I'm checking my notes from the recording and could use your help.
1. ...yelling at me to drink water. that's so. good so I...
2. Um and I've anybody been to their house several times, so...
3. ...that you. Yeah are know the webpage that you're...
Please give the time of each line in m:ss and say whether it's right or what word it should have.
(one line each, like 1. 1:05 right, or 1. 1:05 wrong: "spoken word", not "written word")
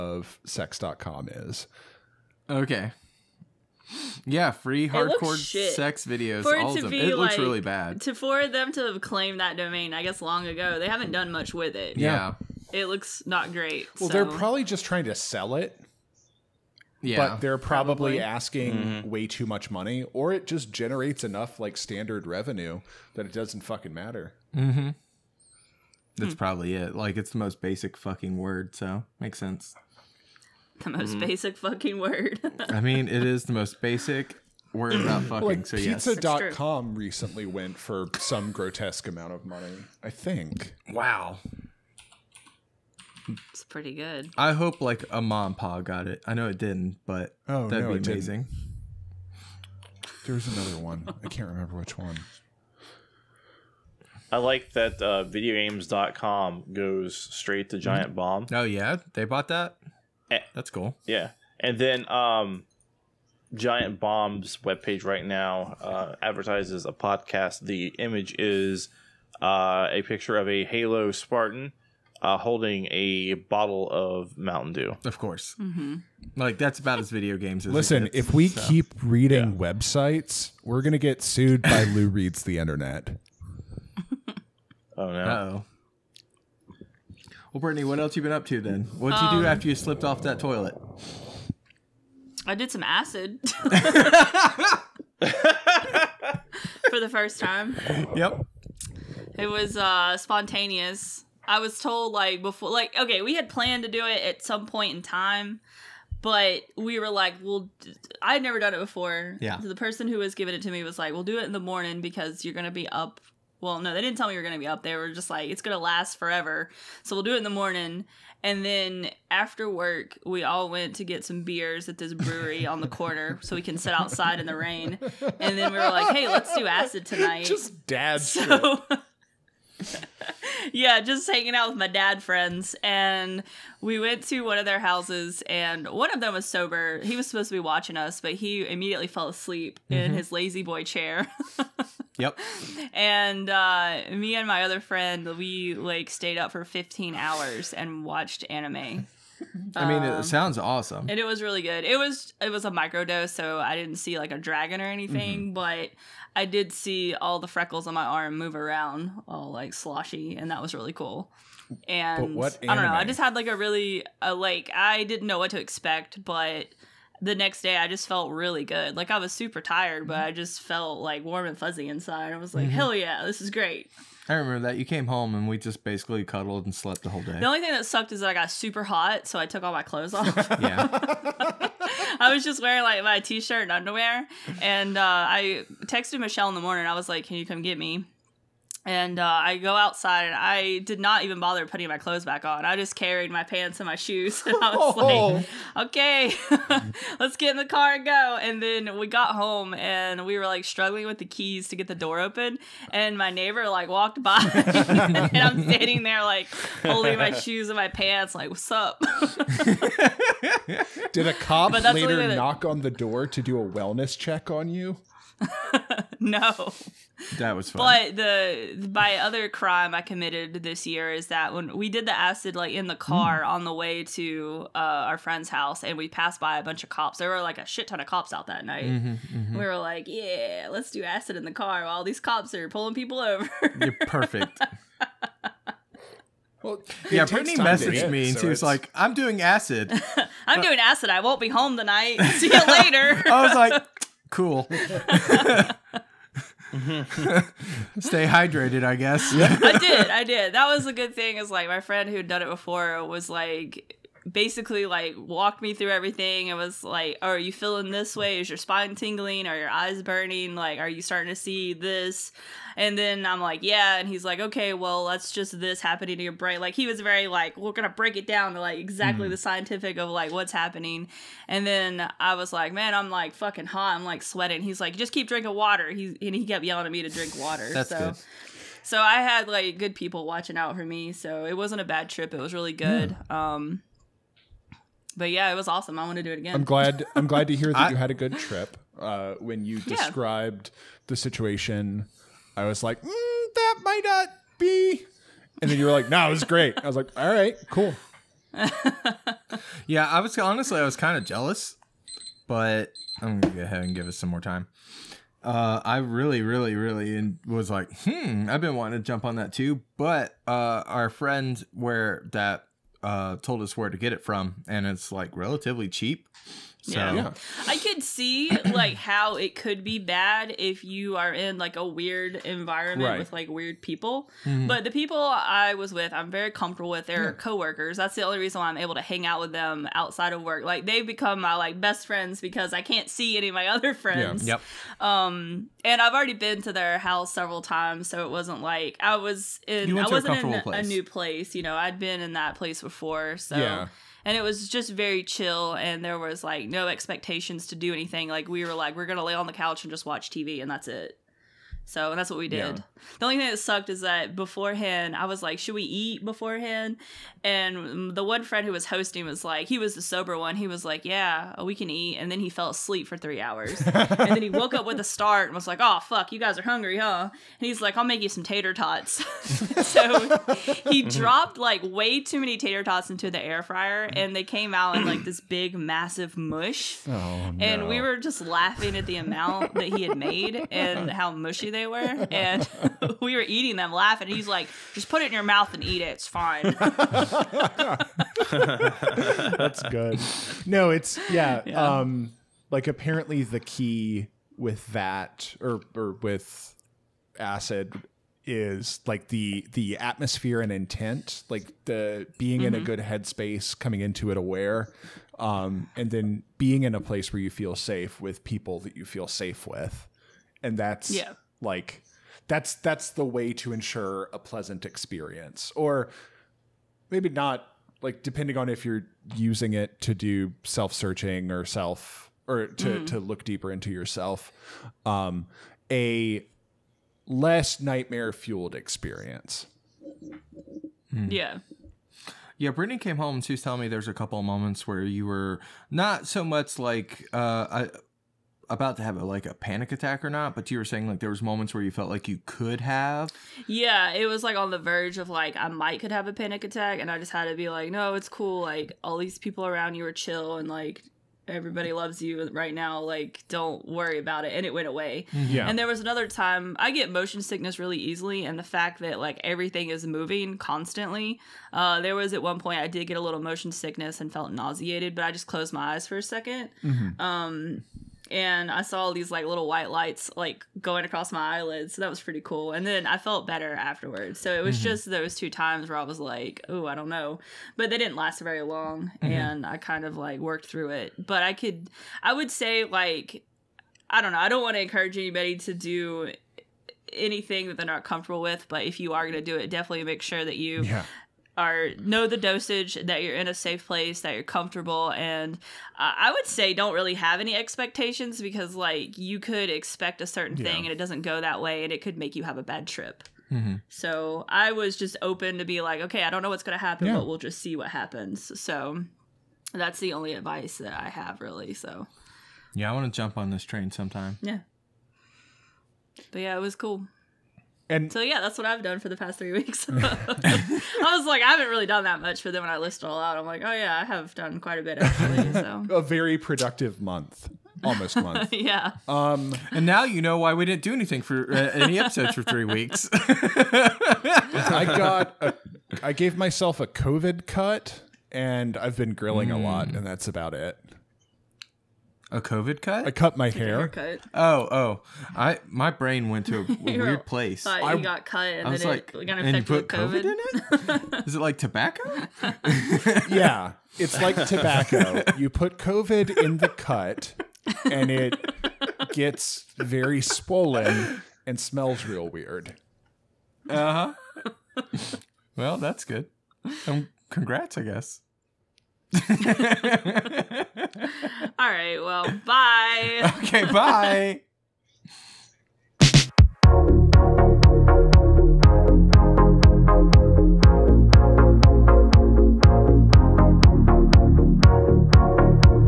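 1. 4:36 right
2. 5:35 wrong: "already", not "anybody"
3. 8:10 wrong: "dosage", not "webpage".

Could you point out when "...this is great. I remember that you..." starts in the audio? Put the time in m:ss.
2:53.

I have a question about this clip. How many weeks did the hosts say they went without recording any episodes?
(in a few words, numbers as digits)
3.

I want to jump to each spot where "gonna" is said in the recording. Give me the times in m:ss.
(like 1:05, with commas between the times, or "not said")
1:52, 5:03, 5:49.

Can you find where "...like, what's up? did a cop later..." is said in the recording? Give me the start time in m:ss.
3:28.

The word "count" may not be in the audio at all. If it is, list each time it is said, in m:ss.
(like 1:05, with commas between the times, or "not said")
not said.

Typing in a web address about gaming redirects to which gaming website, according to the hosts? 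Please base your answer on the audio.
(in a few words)
Giant Bomb.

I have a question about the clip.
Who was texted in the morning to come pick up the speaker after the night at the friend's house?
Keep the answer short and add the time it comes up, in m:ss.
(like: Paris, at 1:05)
Michelle, at 3:06.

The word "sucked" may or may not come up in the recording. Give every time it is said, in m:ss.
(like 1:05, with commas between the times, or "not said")
2:57, 5:53.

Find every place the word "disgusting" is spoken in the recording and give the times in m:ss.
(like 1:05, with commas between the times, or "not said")
not said.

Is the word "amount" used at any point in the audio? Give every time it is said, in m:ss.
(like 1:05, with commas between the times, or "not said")
0:39, 6:19.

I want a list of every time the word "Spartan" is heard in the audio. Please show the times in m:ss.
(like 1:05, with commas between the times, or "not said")
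1:11.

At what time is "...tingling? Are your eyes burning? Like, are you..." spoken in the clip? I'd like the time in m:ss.
4:18.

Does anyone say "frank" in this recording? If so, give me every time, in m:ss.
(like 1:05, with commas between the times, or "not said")
not said.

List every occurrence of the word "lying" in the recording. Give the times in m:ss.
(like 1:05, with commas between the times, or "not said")
not said.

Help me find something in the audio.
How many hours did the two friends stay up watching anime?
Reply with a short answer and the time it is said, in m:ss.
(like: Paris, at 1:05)
15, at 2:26.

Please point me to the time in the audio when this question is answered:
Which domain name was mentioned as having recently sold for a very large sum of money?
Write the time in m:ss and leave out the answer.
0:36.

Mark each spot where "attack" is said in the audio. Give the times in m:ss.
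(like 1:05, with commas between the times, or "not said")
7:19, 7:26.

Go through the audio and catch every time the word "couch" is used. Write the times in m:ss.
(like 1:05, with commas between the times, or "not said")
5:49.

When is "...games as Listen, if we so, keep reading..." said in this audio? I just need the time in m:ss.
1:17.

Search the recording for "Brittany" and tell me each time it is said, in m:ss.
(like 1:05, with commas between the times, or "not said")
1:27, 3:57, 7:12.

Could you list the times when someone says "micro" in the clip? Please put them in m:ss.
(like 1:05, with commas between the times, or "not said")
2:32.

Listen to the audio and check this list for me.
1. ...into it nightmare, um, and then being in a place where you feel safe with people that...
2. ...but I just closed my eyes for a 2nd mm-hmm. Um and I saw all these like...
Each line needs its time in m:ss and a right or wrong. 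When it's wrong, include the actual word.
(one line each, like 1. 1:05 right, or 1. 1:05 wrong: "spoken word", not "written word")
1. 6:44 wrong: "aware", not "nightmare"
2. 7:45 right.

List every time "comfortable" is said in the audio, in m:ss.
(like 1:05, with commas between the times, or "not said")
5:26, 8:08, 8:14.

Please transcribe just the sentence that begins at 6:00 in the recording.
He was like, yeah, we can eat.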